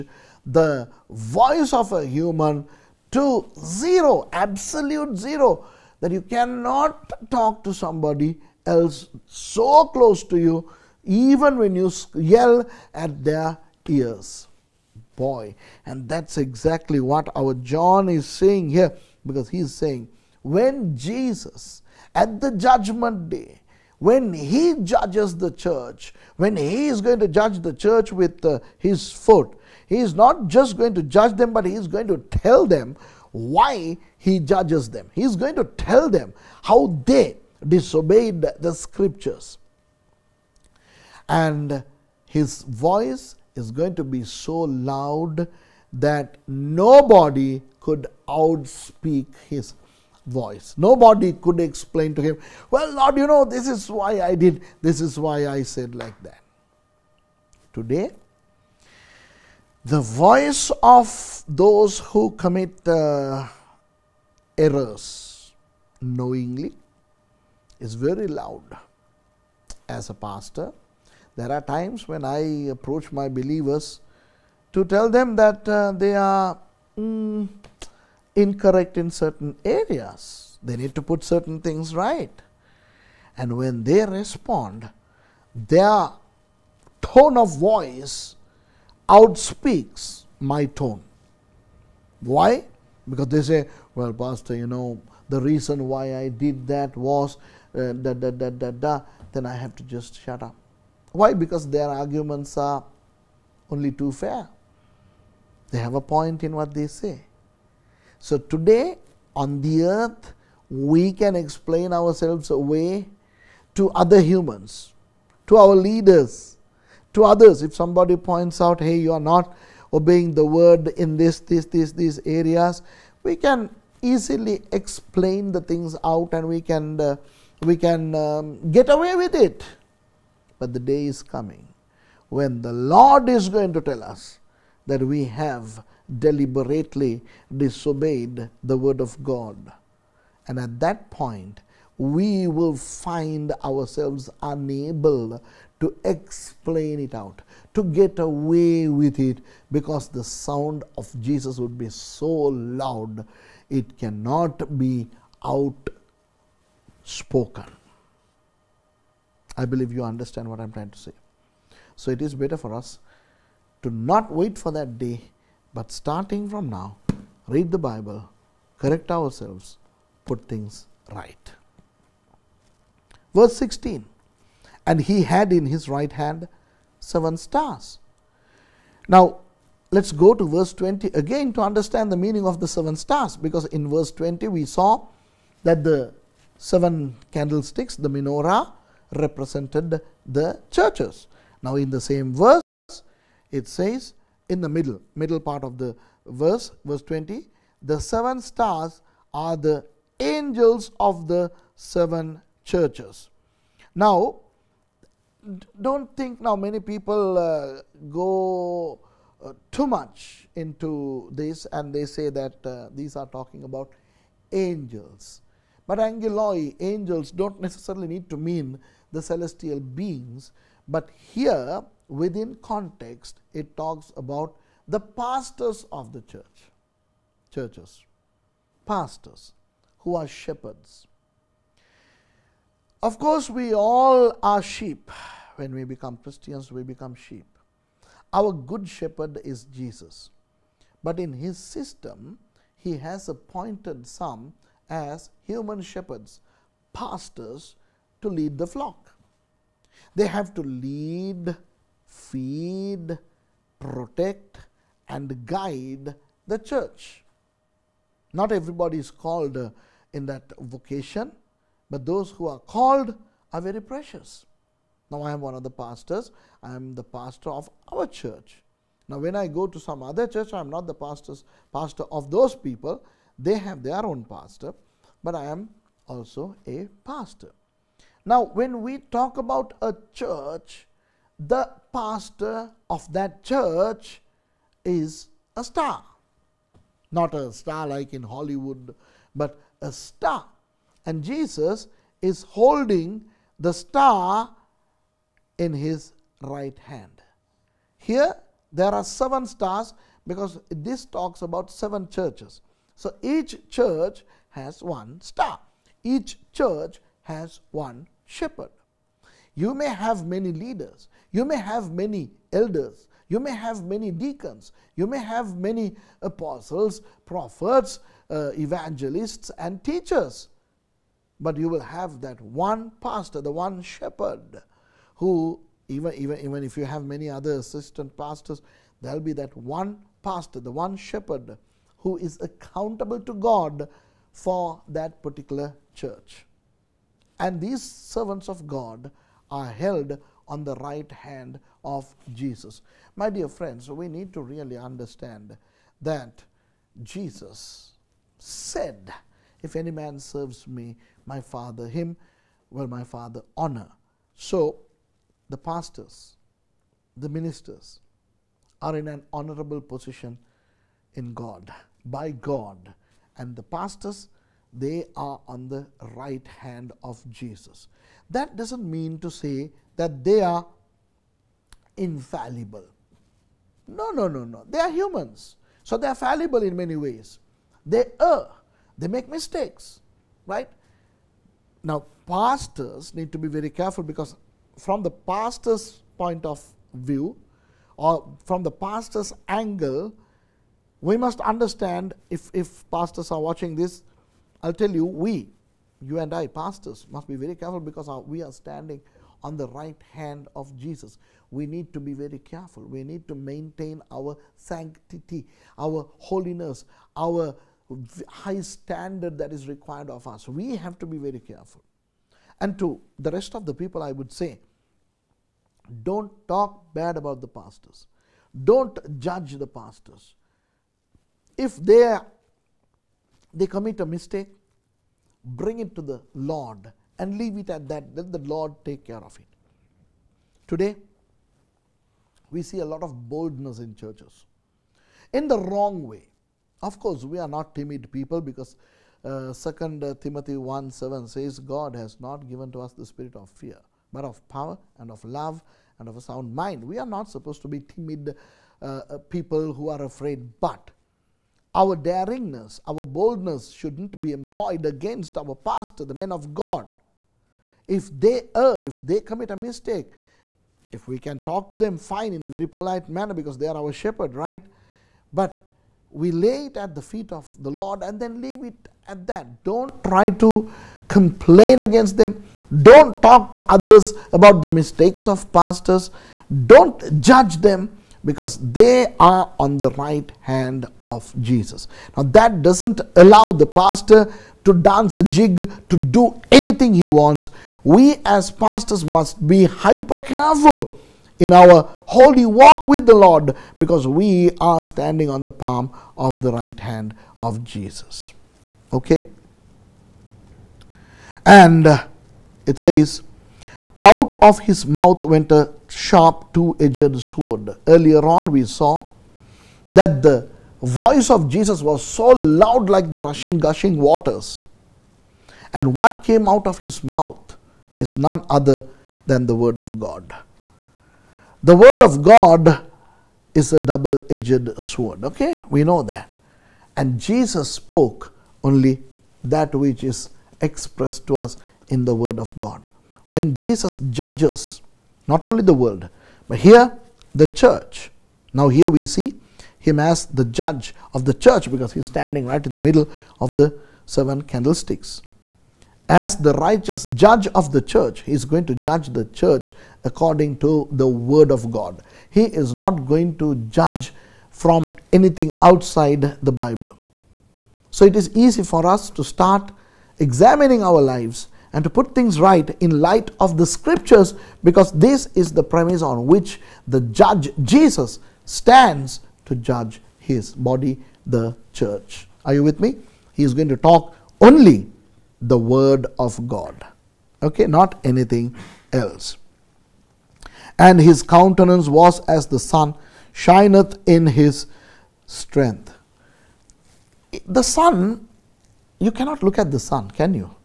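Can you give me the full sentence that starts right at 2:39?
I believe you understand what I'm trying to say.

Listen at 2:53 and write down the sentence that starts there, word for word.
Verse 16 And he had in his right hand seven stars.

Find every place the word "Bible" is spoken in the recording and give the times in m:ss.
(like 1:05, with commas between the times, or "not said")
2:47, 9:16.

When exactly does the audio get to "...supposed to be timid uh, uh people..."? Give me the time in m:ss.
7:27.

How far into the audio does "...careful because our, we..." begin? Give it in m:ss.
6:37.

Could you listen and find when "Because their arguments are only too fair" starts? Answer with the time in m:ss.
1:41.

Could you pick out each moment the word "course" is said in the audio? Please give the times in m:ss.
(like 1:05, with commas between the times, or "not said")
3:53, 7:16.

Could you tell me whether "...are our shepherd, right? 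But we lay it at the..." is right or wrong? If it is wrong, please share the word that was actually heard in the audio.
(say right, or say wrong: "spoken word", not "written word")
right.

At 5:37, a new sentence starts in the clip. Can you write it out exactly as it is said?
And these servants of God are held on the right hand of Jesus.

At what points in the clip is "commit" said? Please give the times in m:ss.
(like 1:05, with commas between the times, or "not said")
1:02, 7:03, 7:39.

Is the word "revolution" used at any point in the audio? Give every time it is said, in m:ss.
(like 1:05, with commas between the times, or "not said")
not said.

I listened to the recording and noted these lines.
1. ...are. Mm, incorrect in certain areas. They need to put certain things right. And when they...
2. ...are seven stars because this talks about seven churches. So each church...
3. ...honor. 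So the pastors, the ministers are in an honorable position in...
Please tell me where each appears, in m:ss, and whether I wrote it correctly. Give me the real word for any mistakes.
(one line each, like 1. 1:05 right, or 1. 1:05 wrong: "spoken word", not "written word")
1. 1:16 right
2. 4:58 right
3. 5:53 right.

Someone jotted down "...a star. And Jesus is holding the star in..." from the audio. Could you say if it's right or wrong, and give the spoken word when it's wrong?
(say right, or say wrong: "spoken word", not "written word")
right.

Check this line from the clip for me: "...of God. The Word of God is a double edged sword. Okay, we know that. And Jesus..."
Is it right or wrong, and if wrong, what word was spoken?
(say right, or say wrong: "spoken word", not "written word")
right.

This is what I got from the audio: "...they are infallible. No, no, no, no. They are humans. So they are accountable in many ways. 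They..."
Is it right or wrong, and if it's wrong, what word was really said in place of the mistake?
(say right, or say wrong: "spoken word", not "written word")
wrong: "fallible", not "accountable".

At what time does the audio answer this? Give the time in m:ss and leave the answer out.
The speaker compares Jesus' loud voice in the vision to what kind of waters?
8:33.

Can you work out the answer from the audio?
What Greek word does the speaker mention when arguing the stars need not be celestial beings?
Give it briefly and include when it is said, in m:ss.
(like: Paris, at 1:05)
Angeloi, at 3:35.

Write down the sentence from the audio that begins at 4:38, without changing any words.
Now, when we talk about a church, the pastor of that church is a star.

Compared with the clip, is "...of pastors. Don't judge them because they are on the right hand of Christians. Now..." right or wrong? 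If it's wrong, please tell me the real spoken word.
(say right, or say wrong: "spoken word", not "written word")
wrong: "Jesus", not "Christians".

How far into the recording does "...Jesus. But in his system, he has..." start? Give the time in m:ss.
3:59.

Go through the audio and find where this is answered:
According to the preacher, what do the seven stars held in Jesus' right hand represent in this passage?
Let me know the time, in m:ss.
3:17.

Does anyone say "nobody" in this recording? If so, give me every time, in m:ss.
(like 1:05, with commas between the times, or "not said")
0:46, 0:50.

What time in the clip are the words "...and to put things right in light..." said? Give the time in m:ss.
9:21.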